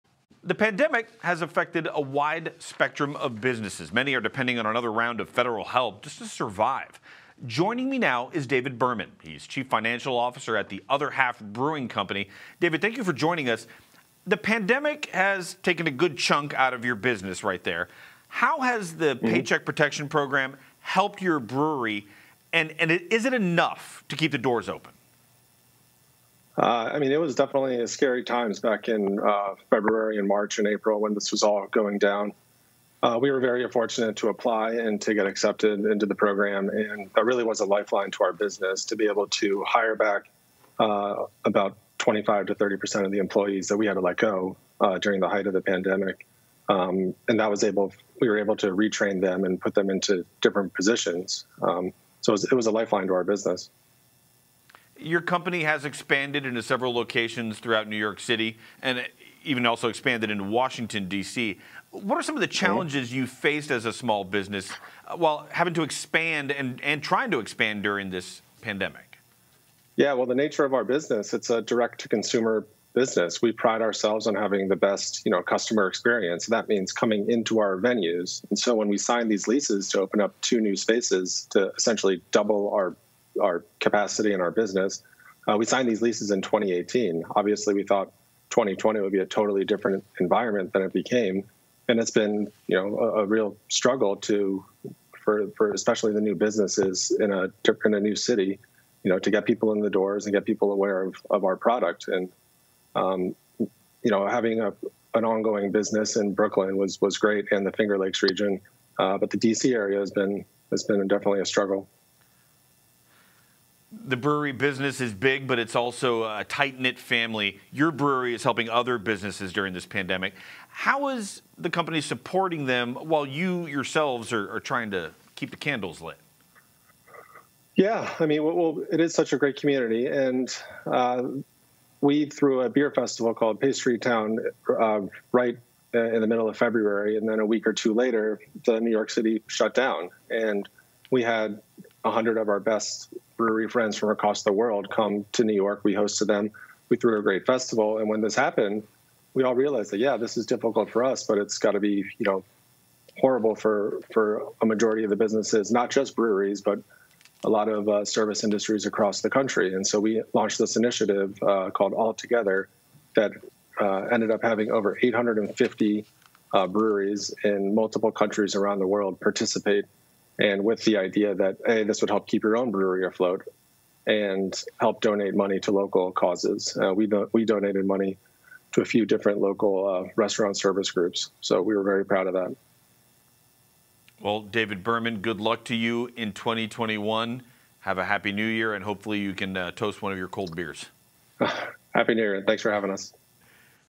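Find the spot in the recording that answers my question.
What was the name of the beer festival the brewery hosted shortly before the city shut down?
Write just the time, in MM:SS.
02:13.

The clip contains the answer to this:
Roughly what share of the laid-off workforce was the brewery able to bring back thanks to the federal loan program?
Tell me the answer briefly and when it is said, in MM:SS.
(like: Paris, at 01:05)
25 to 30 percent, at 00:41.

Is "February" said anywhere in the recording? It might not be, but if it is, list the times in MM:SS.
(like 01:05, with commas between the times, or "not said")
00:29, 02:16.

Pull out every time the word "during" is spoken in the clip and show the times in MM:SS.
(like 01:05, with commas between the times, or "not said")
00:44, 01:07, 01:59.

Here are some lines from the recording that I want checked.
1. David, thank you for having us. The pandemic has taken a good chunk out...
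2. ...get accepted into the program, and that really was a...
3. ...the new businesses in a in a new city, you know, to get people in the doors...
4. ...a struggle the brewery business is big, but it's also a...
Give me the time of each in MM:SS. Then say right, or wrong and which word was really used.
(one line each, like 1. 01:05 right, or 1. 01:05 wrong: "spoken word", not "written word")
1. 00:12 wrong: "joining", not "having"
2. 00:35 right
3. 01:36 right
4. 01:51 right.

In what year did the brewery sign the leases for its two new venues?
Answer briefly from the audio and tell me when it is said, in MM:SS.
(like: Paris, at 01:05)
2018, at 01:26.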